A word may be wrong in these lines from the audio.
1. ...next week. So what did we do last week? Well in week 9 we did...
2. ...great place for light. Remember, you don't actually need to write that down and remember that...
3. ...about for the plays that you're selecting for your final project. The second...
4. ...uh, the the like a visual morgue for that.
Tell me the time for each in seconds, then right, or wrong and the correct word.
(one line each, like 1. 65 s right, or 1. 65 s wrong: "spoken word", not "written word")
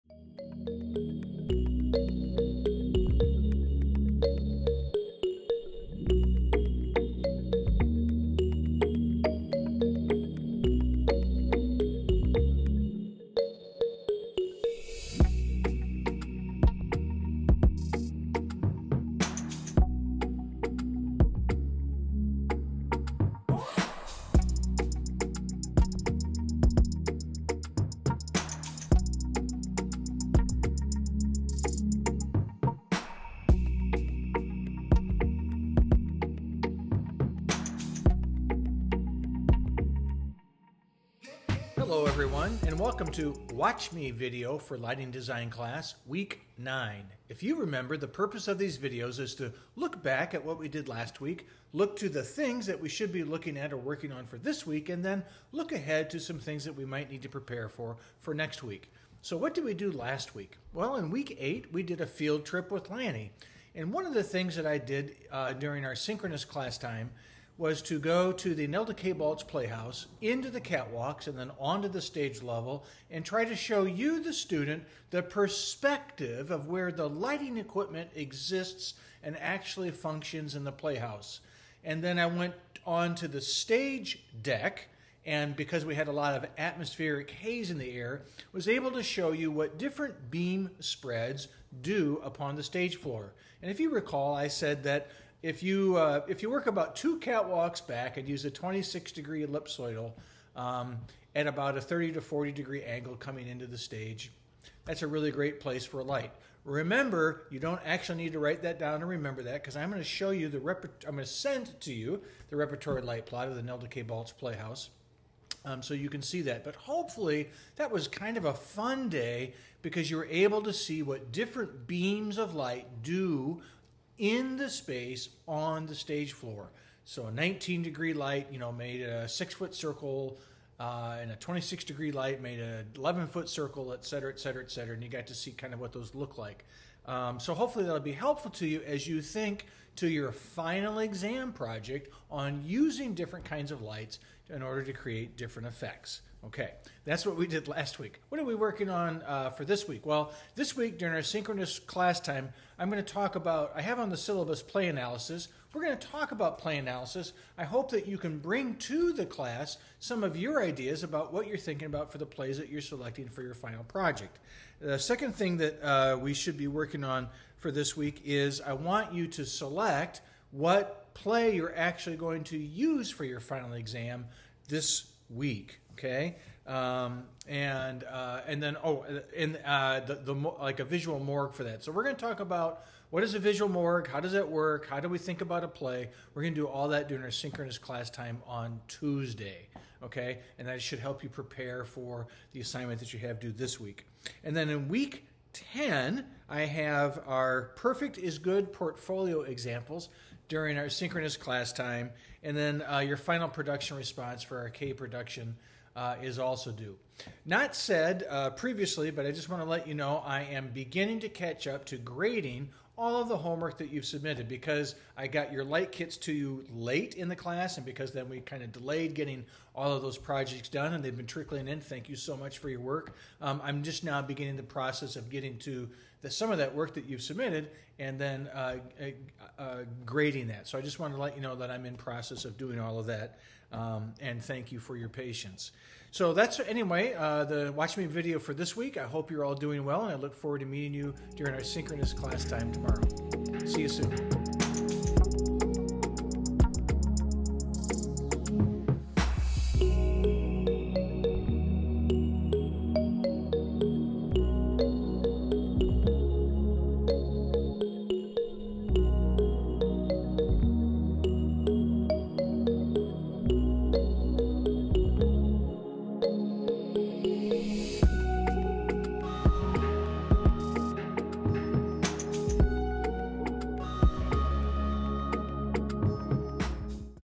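1. 58 s wrong: "8", not "9"
2. 105 s right
3. 161 s right
4. 179 s right.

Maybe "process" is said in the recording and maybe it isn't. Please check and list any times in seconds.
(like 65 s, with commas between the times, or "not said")
224 s, 231 s.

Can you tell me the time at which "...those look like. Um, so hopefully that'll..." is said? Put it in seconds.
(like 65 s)
135 s.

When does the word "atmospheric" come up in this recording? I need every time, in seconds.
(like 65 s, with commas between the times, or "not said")
86 s.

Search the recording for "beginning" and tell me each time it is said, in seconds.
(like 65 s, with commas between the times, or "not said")
210 s, 224 s.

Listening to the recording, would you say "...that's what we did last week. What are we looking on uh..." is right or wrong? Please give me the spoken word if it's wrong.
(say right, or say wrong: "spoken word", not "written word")
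wrong: "working", not "looking".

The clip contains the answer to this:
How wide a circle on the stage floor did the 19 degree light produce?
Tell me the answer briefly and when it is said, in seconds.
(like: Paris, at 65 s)
6 foot, at 129 s.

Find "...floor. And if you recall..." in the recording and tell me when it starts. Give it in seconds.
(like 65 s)
92 s.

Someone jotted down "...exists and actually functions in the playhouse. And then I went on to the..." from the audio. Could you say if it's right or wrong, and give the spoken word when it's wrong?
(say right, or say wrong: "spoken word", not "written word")
right.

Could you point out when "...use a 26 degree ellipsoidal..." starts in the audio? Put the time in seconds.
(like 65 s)
98 s.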